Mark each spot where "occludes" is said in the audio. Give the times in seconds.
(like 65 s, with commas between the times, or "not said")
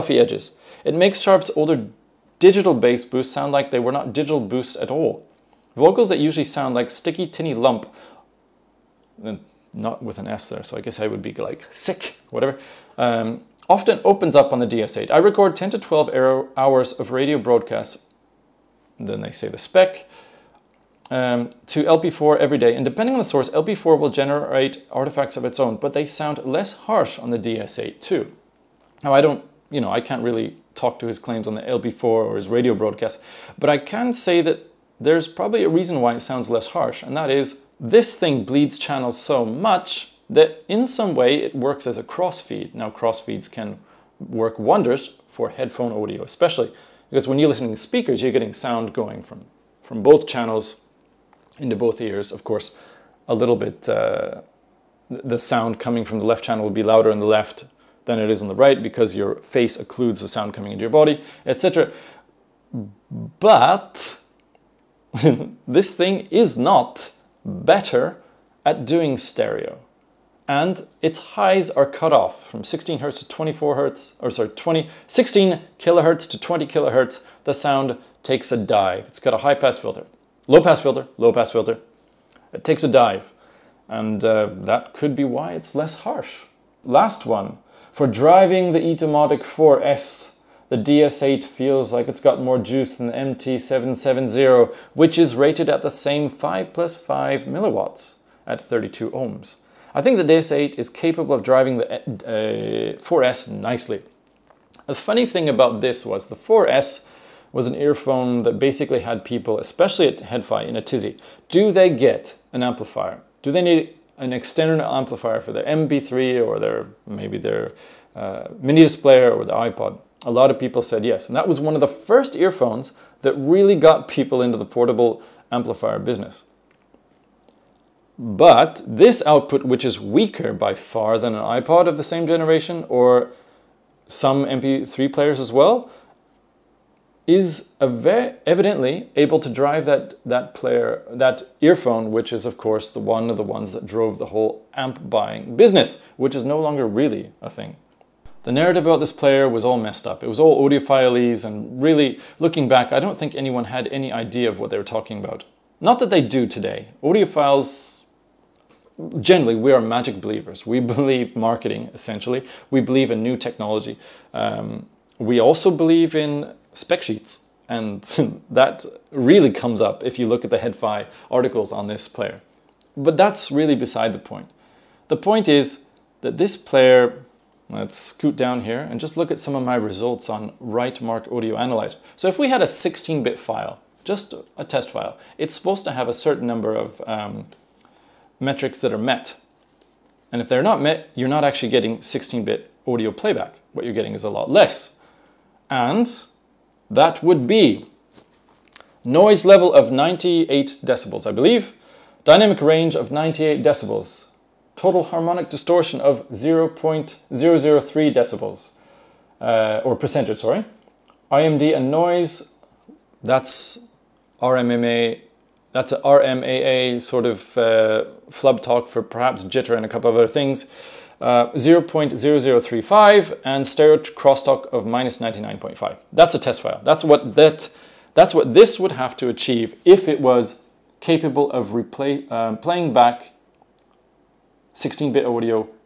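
59 s.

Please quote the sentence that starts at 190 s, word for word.
And if they're not met, you're not actually getting 16-bit audio playback.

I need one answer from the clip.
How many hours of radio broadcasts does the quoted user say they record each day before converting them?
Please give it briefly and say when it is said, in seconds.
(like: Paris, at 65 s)
10 to 12 hours, at 15 s.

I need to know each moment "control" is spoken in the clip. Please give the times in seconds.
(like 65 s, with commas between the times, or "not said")
not said.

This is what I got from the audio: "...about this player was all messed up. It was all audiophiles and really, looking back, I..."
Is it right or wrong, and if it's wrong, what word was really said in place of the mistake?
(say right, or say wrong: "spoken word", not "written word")
right.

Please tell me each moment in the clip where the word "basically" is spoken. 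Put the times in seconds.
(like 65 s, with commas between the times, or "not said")
108 s.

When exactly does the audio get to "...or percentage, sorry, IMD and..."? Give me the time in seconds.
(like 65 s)
209 s.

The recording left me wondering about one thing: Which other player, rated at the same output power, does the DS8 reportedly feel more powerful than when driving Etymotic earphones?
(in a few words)
MT770.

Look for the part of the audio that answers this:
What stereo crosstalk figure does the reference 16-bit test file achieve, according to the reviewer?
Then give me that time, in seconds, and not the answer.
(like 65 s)
224 s.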